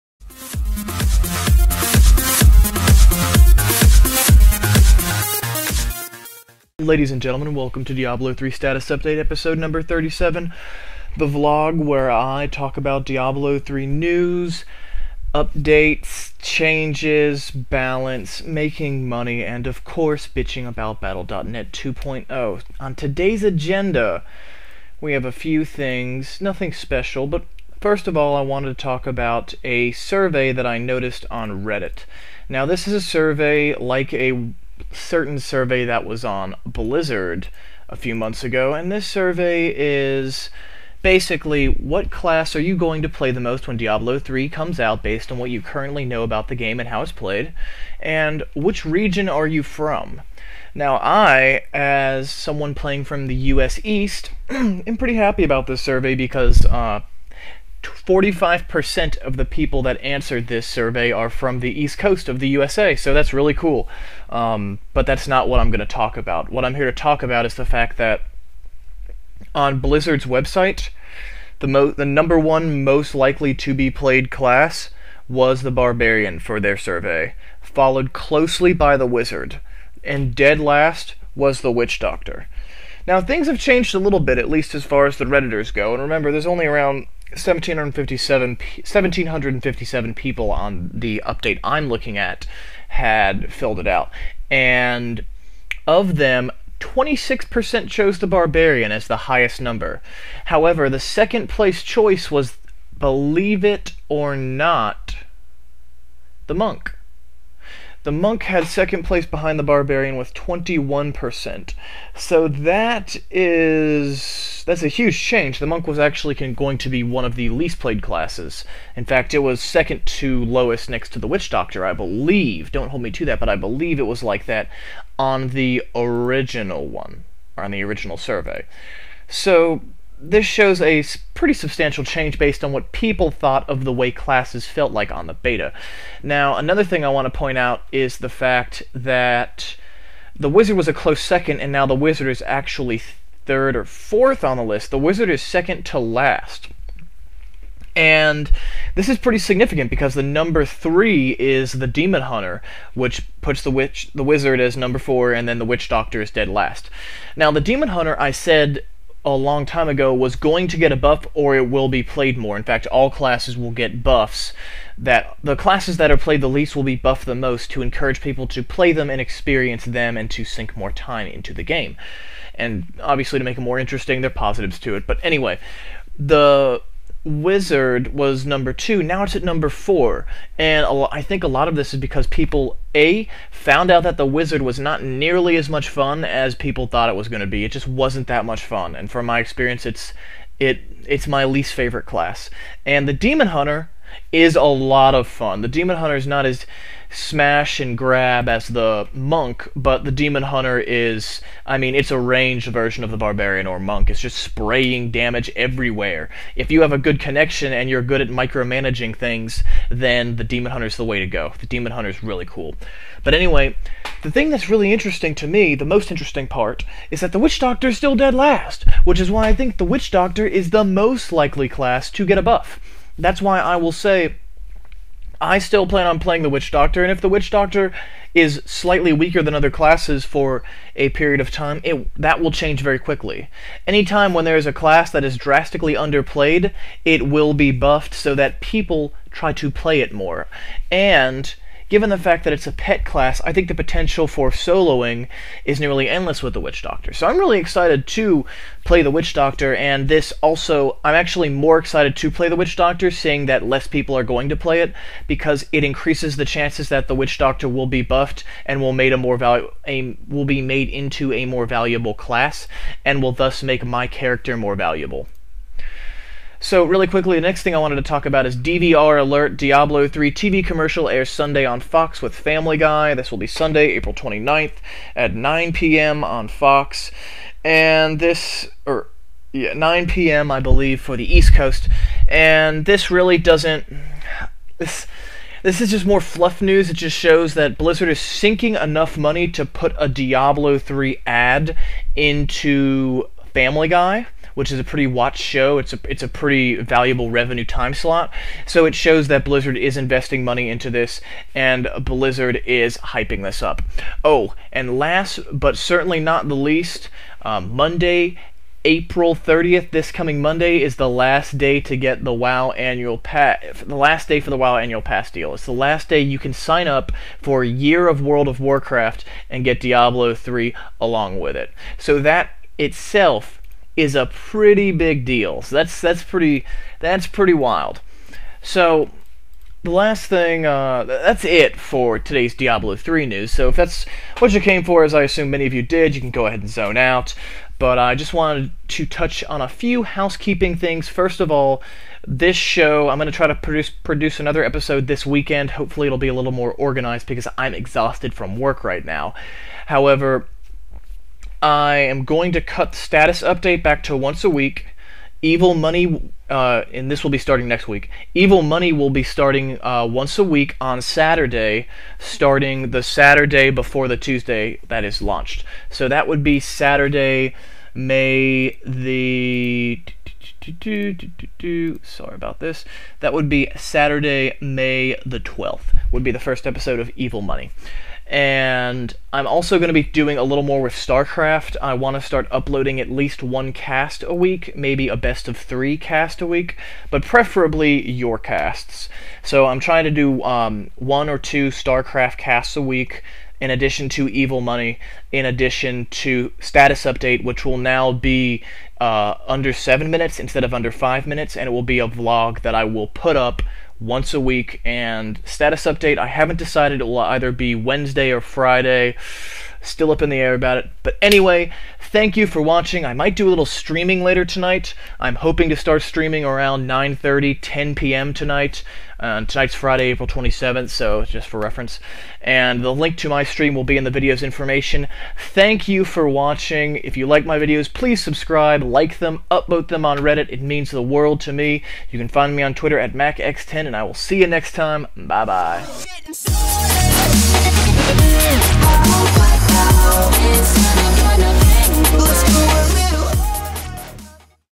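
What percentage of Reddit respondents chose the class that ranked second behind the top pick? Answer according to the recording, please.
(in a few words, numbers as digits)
21%.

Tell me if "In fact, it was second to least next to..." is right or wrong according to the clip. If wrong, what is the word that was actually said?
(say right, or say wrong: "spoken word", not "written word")
wrong: "lowest", not "least".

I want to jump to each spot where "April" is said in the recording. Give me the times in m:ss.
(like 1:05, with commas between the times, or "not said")
4:33, 5:08, 7:00.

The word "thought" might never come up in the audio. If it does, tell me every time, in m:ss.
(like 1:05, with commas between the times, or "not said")
2:13, 3:06.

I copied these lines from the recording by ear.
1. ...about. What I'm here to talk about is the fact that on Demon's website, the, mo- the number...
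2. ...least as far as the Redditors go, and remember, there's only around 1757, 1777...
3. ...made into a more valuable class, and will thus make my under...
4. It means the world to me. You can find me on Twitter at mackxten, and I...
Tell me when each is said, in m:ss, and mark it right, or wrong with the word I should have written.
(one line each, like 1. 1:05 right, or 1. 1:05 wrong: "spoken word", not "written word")
1. 1:06 wrong: "Blizzard", not "Demon"
2. 1:24 wrong: "1757", not "1777"
3. 4:20 wrong: "character", not "under"
4. 7:10 right.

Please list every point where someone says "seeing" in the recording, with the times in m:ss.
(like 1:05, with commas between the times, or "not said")
4:13.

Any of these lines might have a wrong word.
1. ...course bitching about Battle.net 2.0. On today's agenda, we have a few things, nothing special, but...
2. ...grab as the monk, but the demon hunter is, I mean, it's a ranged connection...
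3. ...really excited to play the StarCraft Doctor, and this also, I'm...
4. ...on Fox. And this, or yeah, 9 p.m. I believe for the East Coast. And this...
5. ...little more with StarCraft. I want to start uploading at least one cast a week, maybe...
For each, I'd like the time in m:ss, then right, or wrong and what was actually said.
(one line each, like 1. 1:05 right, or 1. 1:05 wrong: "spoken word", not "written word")
1. 0:19 right
2. 3:17 wrong: "version", not "connection"
3. 4:07 wrong: "Witch", not "StarCraft"
4. 4:36 right
5. 6:20 right.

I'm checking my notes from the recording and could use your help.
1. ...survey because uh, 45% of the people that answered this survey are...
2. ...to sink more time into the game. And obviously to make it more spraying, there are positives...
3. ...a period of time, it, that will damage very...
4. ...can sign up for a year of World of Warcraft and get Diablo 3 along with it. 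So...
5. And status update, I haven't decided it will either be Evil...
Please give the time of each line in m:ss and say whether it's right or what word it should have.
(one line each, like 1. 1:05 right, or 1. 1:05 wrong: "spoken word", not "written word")
1. 0:55 right
2. 2:50 wrong: "interesting", not "spraying"
3. 3:50 wrong: "change", not "damage"
4. 5:16 right
5. 6:44 wrong: "Wednesday", not "Evil".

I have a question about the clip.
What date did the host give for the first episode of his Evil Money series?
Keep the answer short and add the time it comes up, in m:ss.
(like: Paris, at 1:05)
Saturday, May 12th, at 6:13.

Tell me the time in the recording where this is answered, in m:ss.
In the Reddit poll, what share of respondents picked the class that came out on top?
1:36.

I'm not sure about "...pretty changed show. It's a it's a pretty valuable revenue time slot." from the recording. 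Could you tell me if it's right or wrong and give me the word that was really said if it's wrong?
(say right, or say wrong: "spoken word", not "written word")
wrong: "watched", not "changed".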